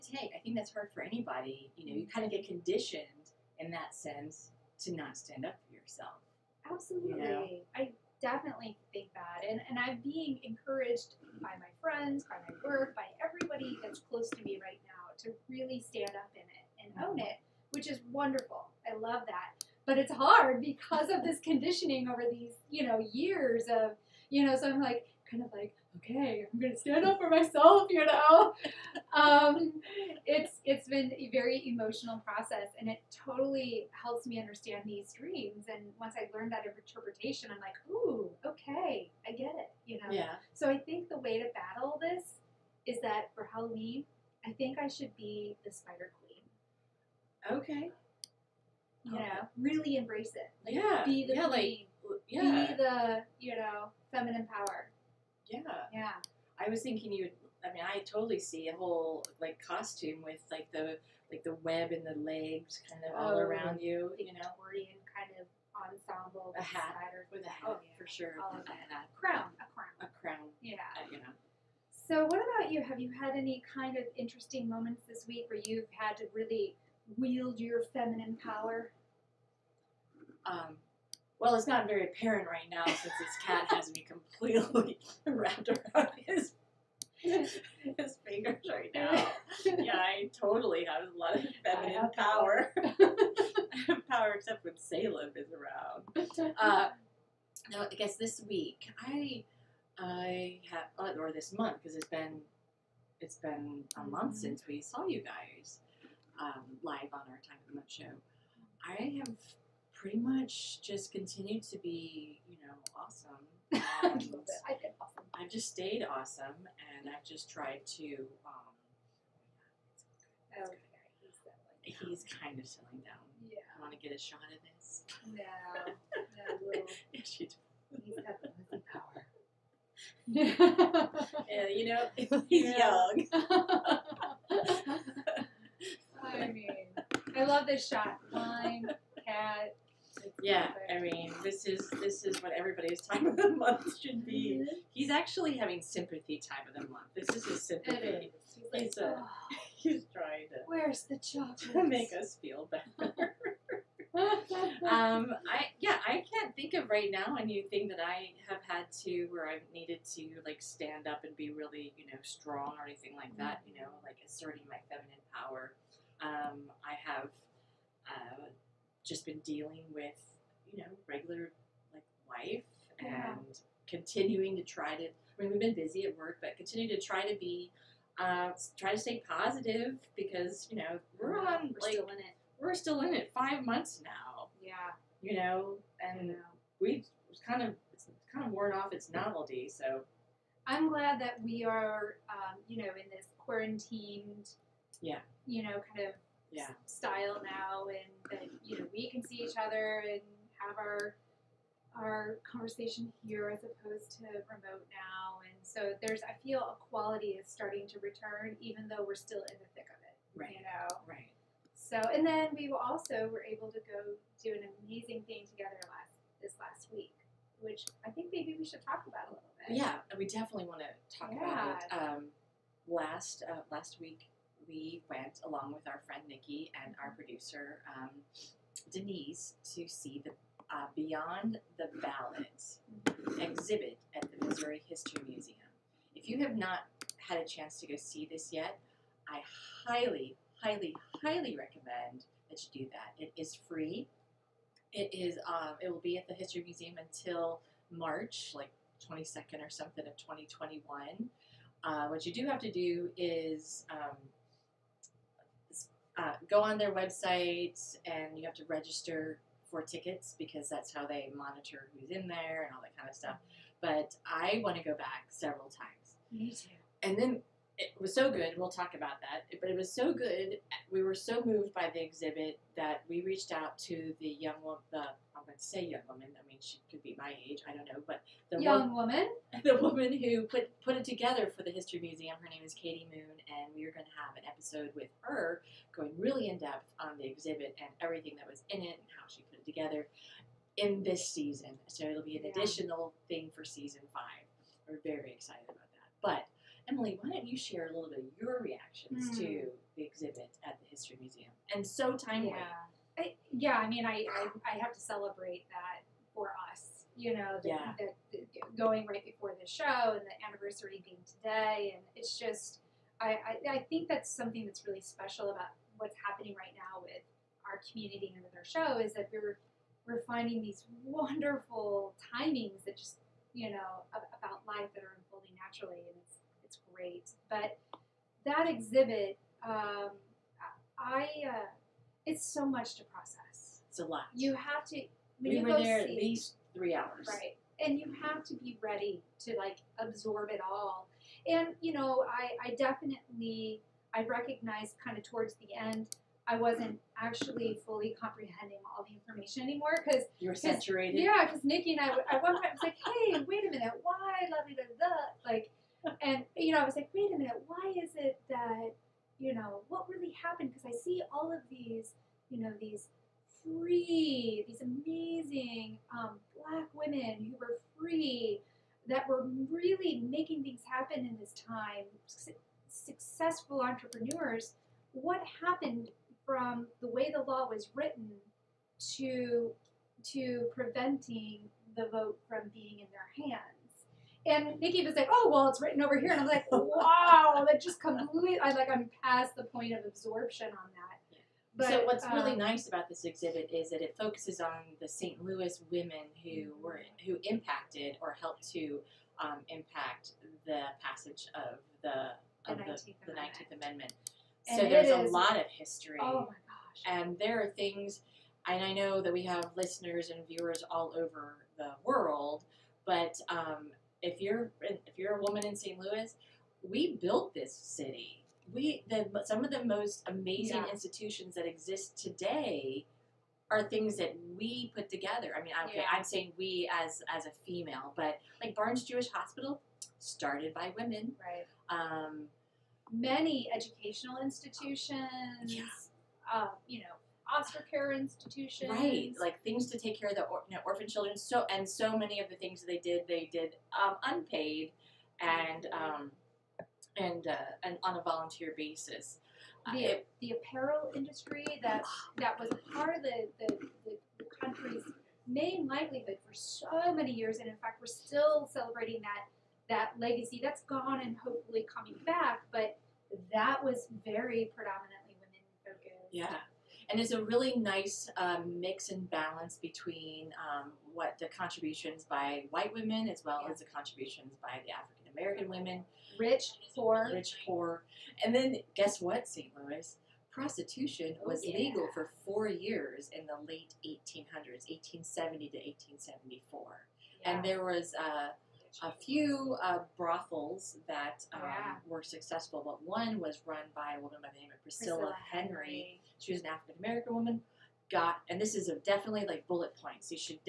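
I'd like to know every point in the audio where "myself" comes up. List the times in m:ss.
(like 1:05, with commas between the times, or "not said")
0:27.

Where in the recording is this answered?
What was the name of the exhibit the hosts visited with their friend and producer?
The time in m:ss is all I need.
3:50.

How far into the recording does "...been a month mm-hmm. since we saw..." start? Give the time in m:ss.
1:43.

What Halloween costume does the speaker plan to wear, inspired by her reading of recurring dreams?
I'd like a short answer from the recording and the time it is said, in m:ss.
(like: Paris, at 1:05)
Spider Queen, at 0:45.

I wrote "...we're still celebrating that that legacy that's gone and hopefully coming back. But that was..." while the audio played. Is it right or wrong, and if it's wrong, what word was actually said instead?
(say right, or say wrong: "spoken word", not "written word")
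right.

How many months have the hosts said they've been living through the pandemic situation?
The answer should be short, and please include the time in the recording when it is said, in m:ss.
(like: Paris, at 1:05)
5 months, at 3:03.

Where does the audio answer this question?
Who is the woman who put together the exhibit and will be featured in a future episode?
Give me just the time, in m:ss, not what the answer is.
4:42.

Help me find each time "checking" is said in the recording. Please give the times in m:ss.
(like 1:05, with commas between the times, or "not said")
not said.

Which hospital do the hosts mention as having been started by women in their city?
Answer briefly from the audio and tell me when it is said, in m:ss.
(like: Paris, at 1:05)
Barnes Jewish Hospital, at 7:08.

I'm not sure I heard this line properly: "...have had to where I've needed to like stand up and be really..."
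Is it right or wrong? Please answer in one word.
right.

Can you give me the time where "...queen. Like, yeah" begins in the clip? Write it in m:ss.
0:51.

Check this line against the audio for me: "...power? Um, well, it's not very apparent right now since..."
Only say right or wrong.
right.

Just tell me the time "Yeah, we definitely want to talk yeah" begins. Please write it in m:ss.
3:39.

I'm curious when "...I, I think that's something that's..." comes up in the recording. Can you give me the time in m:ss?
5:13.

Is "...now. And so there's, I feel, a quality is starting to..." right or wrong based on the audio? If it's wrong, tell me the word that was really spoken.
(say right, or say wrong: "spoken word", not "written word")
right.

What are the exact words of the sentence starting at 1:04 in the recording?
you know, Victorian kind of ensemble.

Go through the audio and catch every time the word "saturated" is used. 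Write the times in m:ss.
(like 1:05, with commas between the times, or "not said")
5:50.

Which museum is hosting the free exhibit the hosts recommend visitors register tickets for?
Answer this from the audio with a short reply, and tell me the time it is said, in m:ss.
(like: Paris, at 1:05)
Missouri History Museum, at 3:54.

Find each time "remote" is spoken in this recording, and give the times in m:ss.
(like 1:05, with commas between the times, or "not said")
3:24.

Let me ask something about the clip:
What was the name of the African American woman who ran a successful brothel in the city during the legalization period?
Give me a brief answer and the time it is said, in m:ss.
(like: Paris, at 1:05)
Priscilla Henry, at 8:15.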